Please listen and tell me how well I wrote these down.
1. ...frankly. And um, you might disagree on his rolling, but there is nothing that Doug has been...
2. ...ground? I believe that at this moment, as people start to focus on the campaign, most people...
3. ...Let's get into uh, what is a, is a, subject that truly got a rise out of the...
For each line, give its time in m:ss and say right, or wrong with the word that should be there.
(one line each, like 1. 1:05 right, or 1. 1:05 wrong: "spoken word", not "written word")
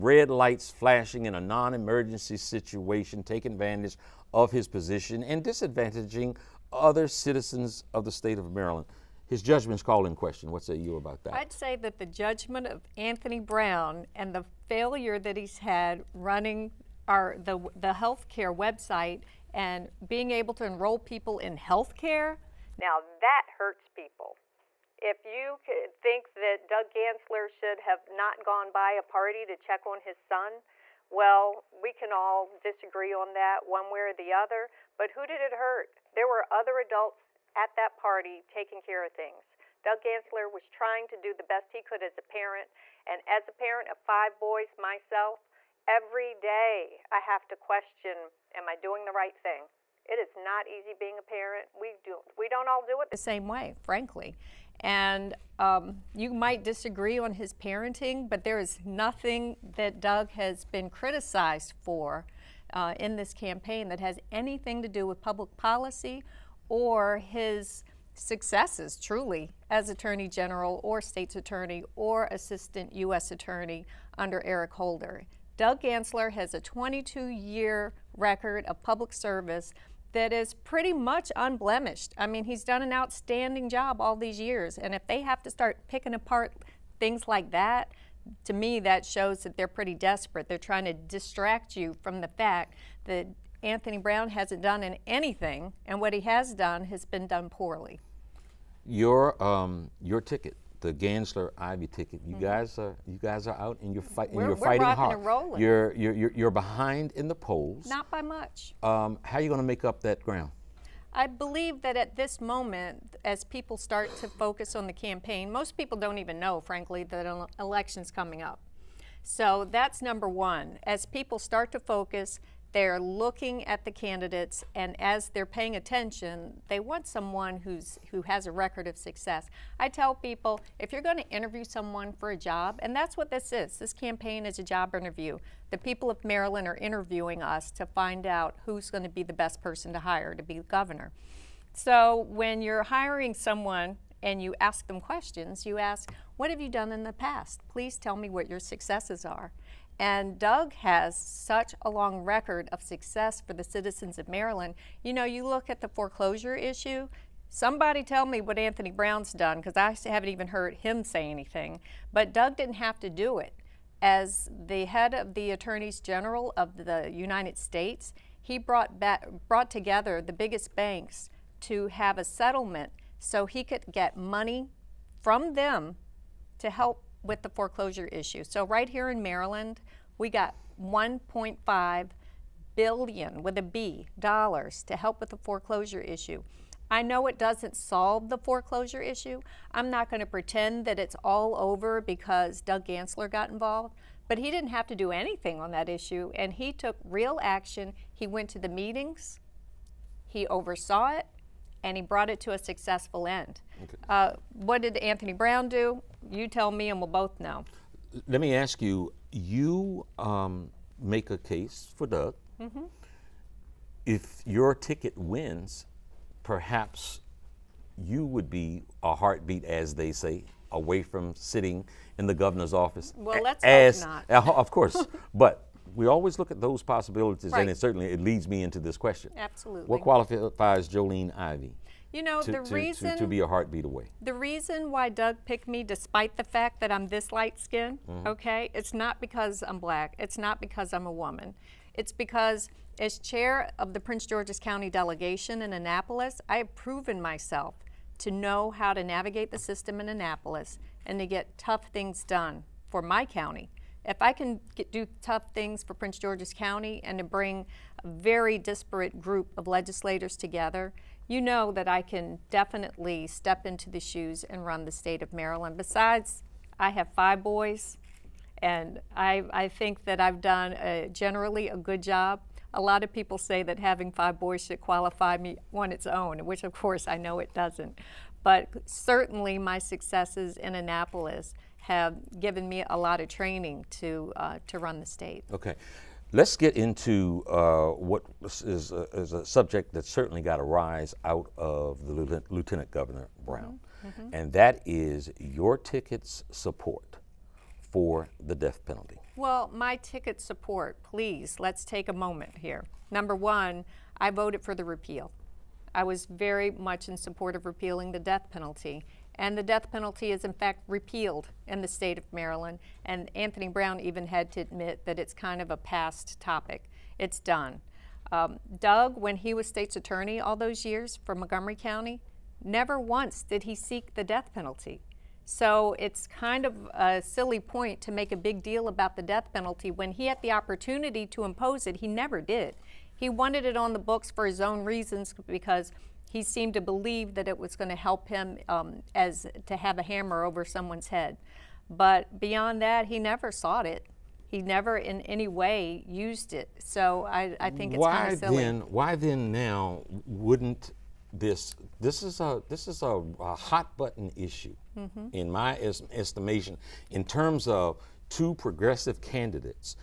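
1. 0:53 wrong: "parenting", not "rolling"
2. 1:50 right
3. 4:46 wrong: "certainly", not "truly".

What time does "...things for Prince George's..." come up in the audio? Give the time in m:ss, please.
4:15.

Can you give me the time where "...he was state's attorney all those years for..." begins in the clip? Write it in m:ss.
5:19.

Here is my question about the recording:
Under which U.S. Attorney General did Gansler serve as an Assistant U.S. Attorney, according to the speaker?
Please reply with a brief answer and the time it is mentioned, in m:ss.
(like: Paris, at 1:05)
Eric Holder, at 1:14.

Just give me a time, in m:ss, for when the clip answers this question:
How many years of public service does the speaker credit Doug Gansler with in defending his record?
1:16.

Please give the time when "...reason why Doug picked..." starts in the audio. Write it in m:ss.
3:54.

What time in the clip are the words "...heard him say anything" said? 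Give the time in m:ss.
2:40.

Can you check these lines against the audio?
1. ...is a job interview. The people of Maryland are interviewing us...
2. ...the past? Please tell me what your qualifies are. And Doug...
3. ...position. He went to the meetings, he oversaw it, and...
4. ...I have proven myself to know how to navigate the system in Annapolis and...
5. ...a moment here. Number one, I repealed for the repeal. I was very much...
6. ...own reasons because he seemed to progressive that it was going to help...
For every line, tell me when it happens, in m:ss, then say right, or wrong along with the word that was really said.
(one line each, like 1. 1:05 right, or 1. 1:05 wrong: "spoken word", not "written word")
1. 2:14 right
2. 2:27 wrong: "successes", not "qualifies"
3. 3:17 wrong: "action", not "position"
4. 4:06 right
5. 5:02 wrong: "voted", not "repealed"
6. 5:34 wrong: "believe", not "progressive".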